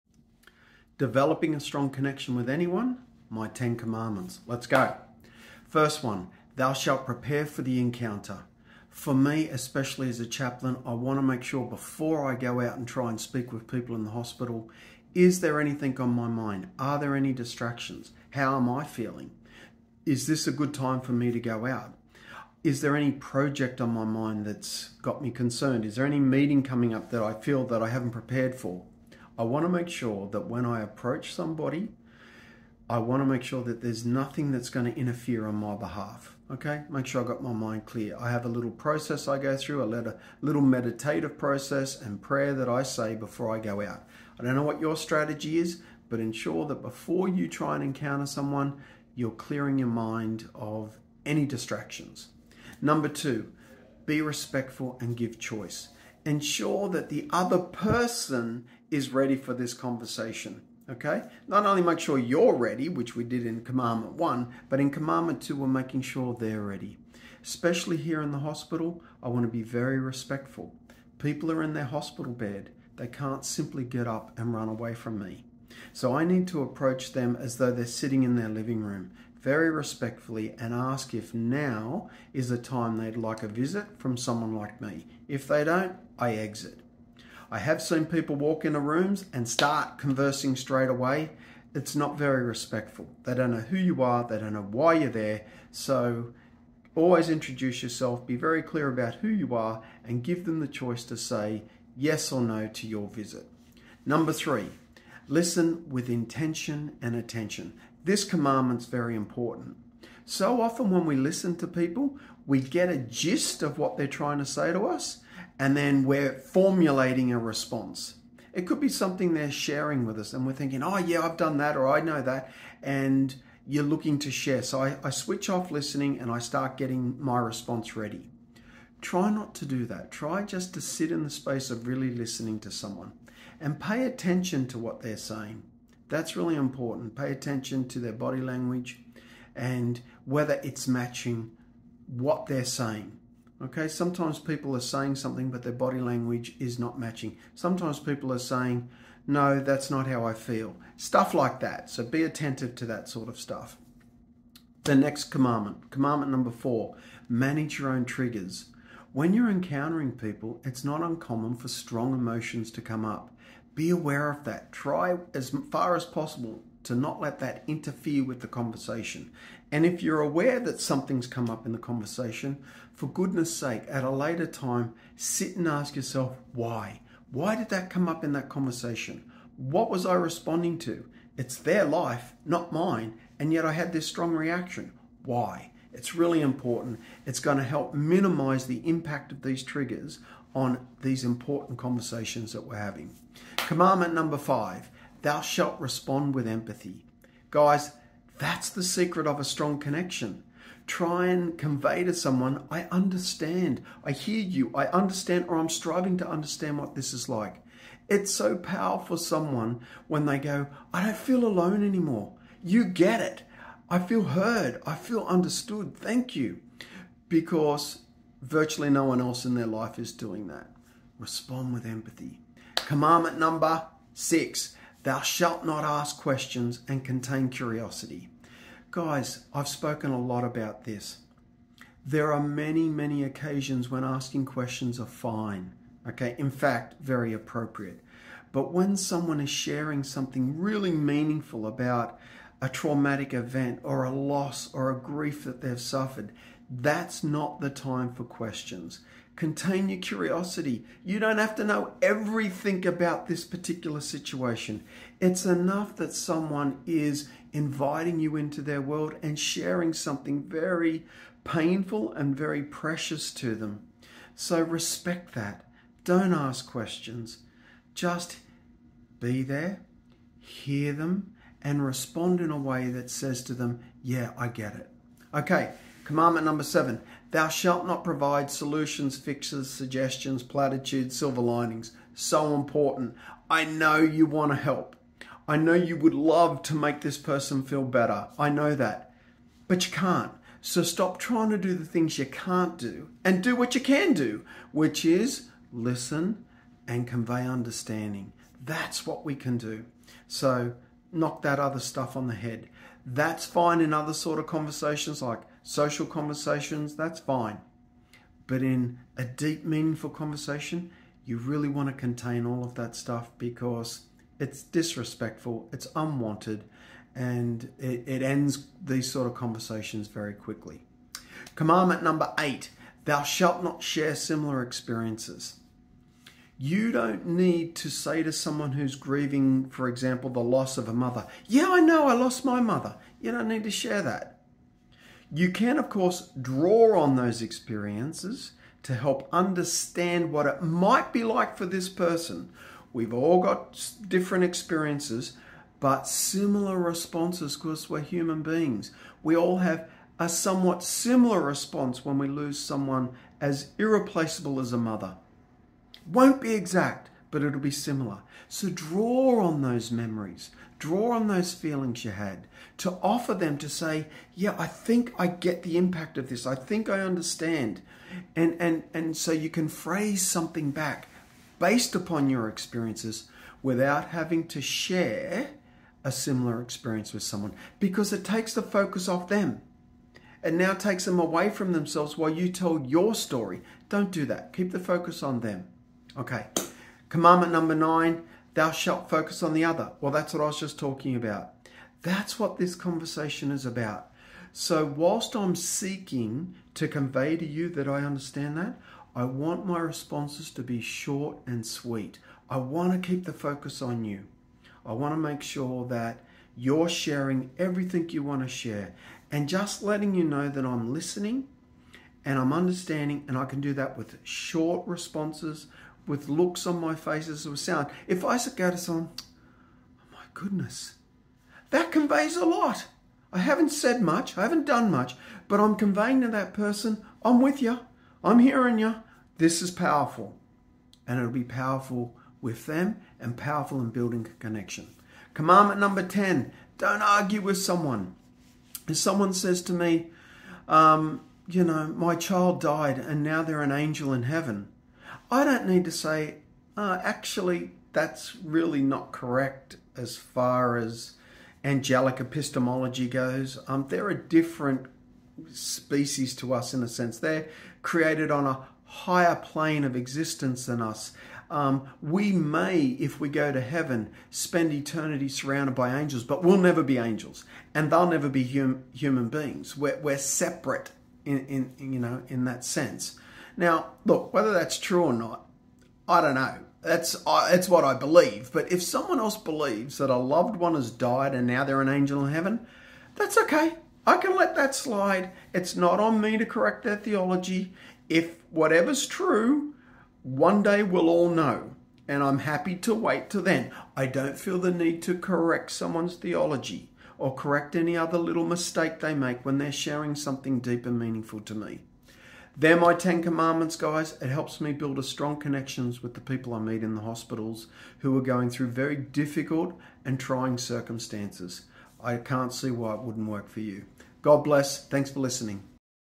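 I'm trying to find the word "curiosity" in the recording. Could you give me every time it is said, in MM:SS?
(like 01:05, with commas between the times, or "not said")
03:47, 04:09.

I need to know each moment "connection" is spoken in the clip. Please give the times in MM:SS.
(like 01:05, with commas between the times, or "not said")
00:01, 03:19, 07:14, 08:25.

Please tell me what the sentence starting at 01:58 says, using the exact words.
It could be something they're sharing with us, and we're thinking, oh, yeah, I've done that, or I know that.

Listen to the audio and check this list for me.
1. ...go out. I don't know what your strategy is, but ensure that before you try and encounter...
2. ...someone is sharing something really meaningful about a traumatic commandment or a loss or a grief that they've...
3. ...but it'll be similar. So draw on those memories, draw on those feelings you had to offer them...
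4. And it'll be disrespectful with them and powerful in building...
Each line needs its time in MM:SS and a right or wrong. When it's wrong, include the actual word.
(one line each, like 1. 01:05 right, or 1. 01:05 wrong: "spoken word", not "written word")
1. 00:43 right
2. 03:58 wrong: "event", not "commandment"
3. 05:57 right
4. 07:11 wrong: "powerful", not "disrespectful".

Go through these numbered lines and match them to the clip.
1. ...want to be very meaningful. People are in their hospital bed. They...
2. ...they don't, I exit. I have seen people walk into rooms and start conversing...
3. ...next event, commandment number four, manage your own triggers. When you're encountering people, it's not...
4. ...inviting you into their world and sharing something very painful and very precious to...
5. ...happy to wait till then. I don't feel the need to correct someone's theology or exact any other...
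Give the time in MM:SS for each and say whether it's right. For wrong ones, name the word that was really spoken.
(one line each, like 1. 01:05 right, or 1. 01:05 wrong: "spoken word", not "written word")
1. 01:09 wrong: "respectful", not "meaningful"
2. 01:25 right
3. 02:34 wrong: "commandment", not "event"
4. 04:17 right
5. 08:12 wrong: "correct", not "exact".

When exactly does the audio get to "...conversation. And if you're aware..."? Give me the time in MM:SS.
02:48.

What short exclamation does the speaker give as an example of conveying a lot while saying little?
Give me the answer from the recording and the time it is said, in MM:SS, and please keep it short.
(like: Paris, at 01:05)
oh my goodness, at 06:59.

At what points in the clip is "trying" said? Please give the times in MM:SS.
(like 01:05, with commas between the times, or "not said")
01:54, 04:51, 08:30.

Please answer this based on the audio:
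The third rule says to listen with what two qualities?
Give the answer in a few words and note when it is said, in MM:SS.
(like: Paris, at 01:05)
intention and attention, at 01:46.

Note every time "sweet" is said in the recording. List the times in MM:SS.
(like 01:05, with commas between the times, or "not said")
06:41.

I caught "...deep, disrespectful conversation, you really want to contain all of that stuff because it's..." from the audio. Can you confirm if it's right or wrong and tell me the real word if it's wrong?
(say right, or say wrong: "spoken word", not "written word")
wrong: "meaningful", not "disrespectful".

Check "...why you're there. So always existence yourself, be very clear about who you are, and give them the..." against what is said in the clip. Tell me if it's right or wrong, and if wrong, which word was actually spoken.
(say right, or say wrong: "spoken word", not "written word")
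wrong: "introduce", not "existence".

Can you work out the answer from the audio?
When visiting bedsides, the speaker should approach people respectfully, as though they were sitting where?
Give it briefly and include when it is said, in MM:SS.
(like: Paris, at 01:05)
their living room, at 01:18.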